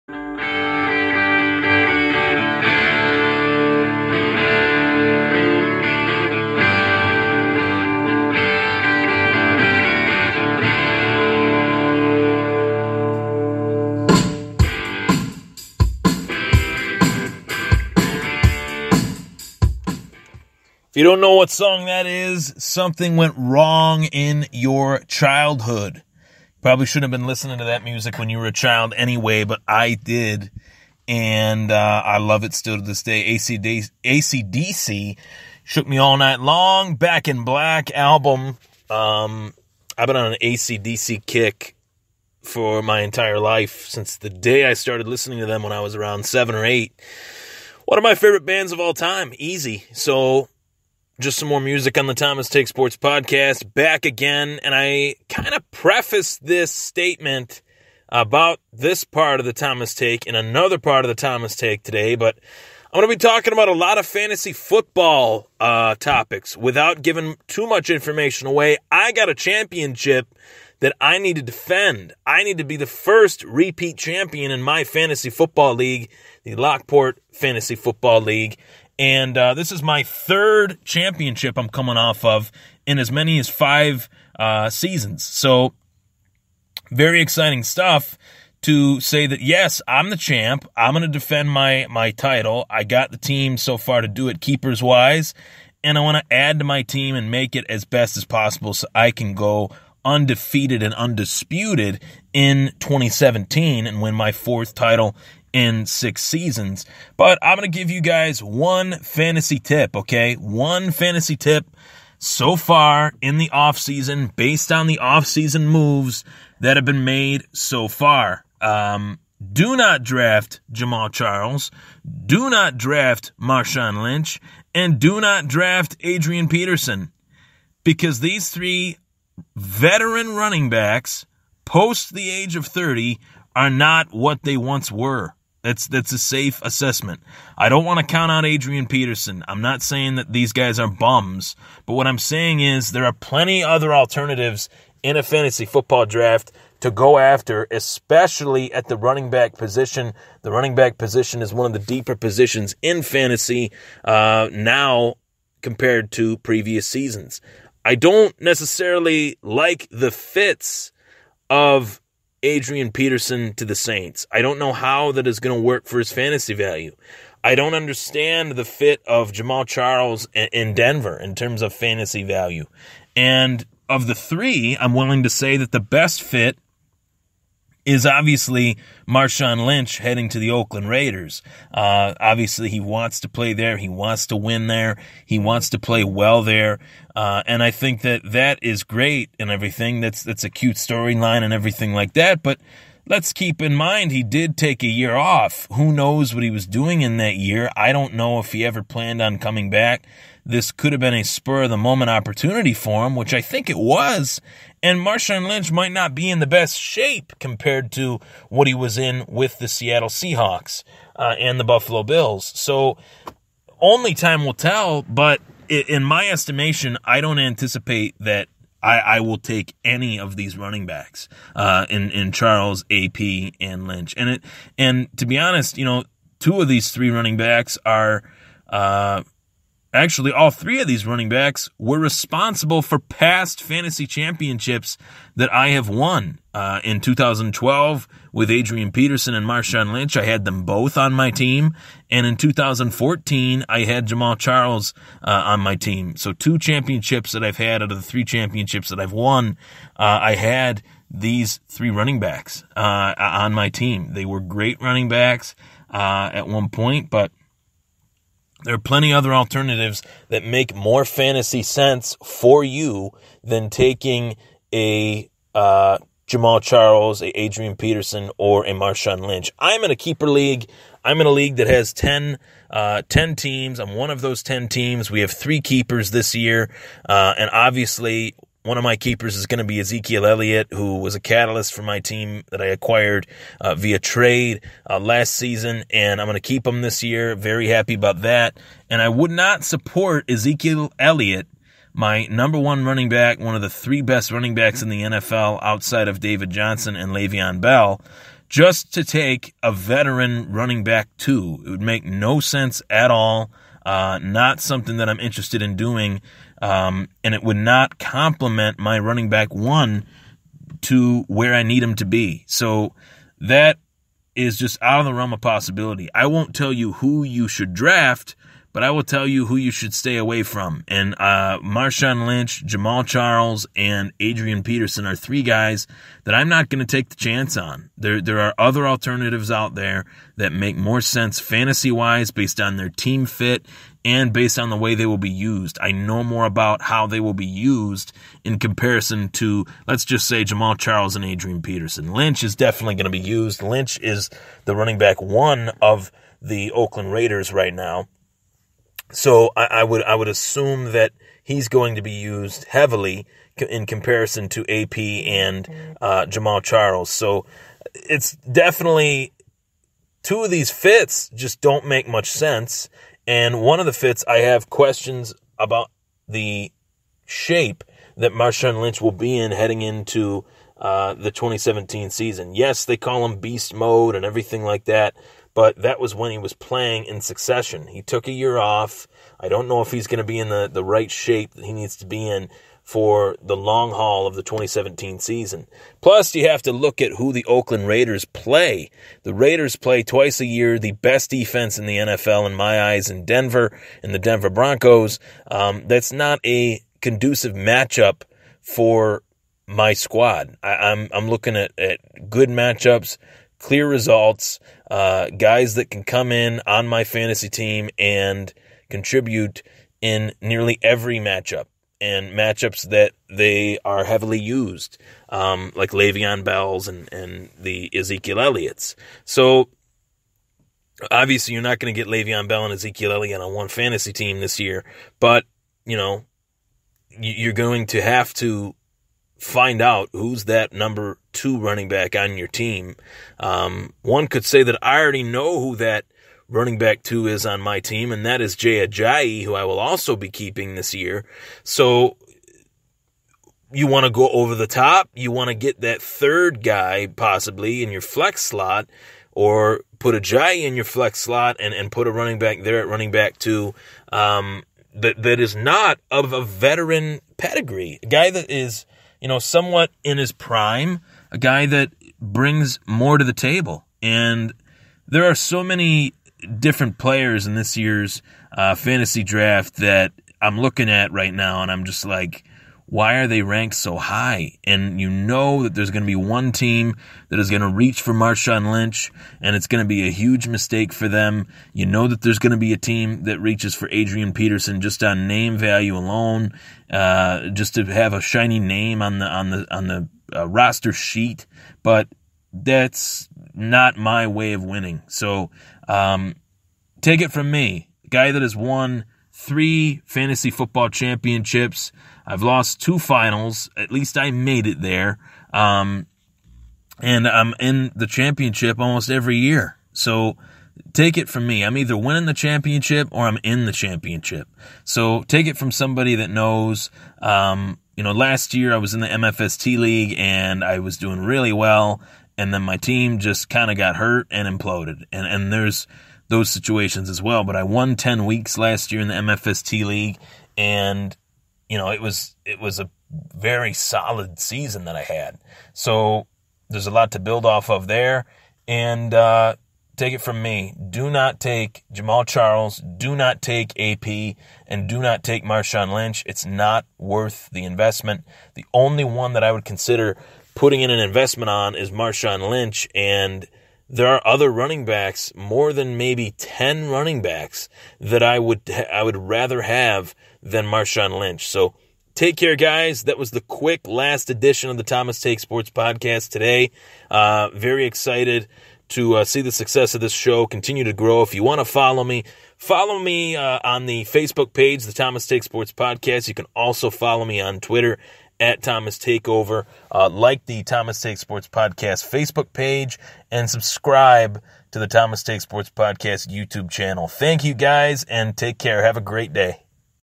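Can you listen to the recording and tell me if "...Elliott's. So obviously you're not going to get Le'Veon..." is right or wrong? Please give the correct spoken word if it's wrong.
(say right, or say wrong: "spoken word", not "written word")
right.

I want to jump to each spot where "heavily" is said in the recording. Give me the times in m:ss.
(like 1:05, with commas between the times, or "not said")
5:52, 6:54.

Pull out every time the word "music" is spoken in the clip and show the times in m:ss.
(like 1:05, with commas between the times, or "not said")
0:27, 0:51.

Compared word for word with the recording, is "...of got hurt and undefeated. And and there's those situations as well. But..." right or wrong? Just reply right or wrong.
wrong.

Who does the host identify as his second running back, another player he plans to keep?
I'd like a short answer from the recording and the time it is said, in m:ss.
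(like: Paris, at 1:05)
Jay Ajayi, at 7:18.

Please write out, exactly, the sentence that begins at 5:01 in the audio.
It would make no sense at all.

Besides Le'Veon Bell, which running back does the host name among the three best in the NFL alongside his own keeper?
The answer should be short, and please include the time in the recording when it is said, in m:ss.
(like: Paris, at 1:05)
David Johnson, at 4:56.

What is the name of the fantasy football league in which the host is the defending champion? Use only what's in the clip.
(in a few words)
Lockport Fantasy Football League.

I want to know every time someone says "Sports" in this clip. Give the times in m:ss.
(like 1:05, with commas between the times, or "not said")
0:52, 9:25, 9:35, 9:41, 9:45.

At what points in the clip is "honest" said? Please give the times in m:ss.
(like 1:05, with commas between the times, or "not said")
3:45.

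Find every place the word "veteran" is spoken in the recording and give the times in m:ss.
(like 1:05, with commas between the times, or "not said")
2:09, 4:59, 7:36.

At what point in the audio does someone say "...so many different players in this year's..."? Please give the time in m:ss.
7:45.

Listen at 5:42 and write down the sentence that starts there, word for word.
Lynch is definitely going to be used.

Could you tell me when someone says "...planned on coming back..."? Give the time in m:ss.
3:18.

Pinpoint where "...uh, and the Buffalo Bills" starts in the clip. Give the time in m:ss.
3:31.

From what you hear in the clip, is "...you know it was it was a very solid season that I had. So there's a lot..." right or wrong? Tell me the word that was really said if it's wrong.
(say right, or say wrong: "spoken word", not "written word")
right.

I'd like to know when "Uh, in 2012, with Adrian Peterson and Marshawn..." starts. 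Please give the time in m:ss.
3:56.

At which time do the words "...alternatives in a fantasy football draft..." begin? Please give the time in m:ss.
2:23.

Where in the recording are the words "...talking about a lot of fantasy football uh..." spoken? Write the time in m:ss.
1:03.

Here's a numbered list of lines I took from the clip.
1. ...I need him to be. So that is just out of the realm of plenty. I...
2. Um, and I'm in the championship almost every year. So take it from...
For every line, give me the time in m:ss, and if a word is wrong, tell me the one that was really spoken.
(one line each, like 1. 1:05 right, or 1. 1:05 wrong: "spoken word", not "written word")
1. 5:11 wrong: "possibility", not "plenty"
2. 8:25 right.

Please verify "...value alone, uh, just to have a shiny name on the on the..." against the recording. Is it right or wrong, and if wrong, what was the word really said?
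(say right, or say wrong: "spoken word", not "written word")
right.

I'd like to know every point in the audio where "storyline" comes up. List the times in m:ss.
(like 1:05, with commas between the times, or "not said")
3:10.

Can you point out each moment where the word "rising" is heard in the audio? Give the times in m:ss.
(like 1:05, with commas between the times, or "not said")
not said.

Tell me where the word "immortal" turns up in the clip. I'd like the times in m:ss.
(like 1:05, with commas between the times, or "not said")
not said.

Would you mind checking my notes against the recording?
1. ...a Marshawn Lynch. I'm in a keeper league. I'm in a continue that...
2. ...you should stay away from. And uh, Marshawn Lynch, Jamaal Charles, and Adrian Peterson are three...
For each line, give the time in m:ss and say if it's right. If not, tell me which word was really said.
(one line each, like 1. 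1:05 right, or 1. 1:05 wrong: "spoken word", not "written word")
1. 4:28 wrong: "league", not "continue"
2. 5:19 right.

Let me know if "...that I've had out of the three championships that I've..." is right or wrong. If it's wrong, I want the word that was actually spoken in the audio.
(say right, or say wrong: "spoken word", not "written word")
right.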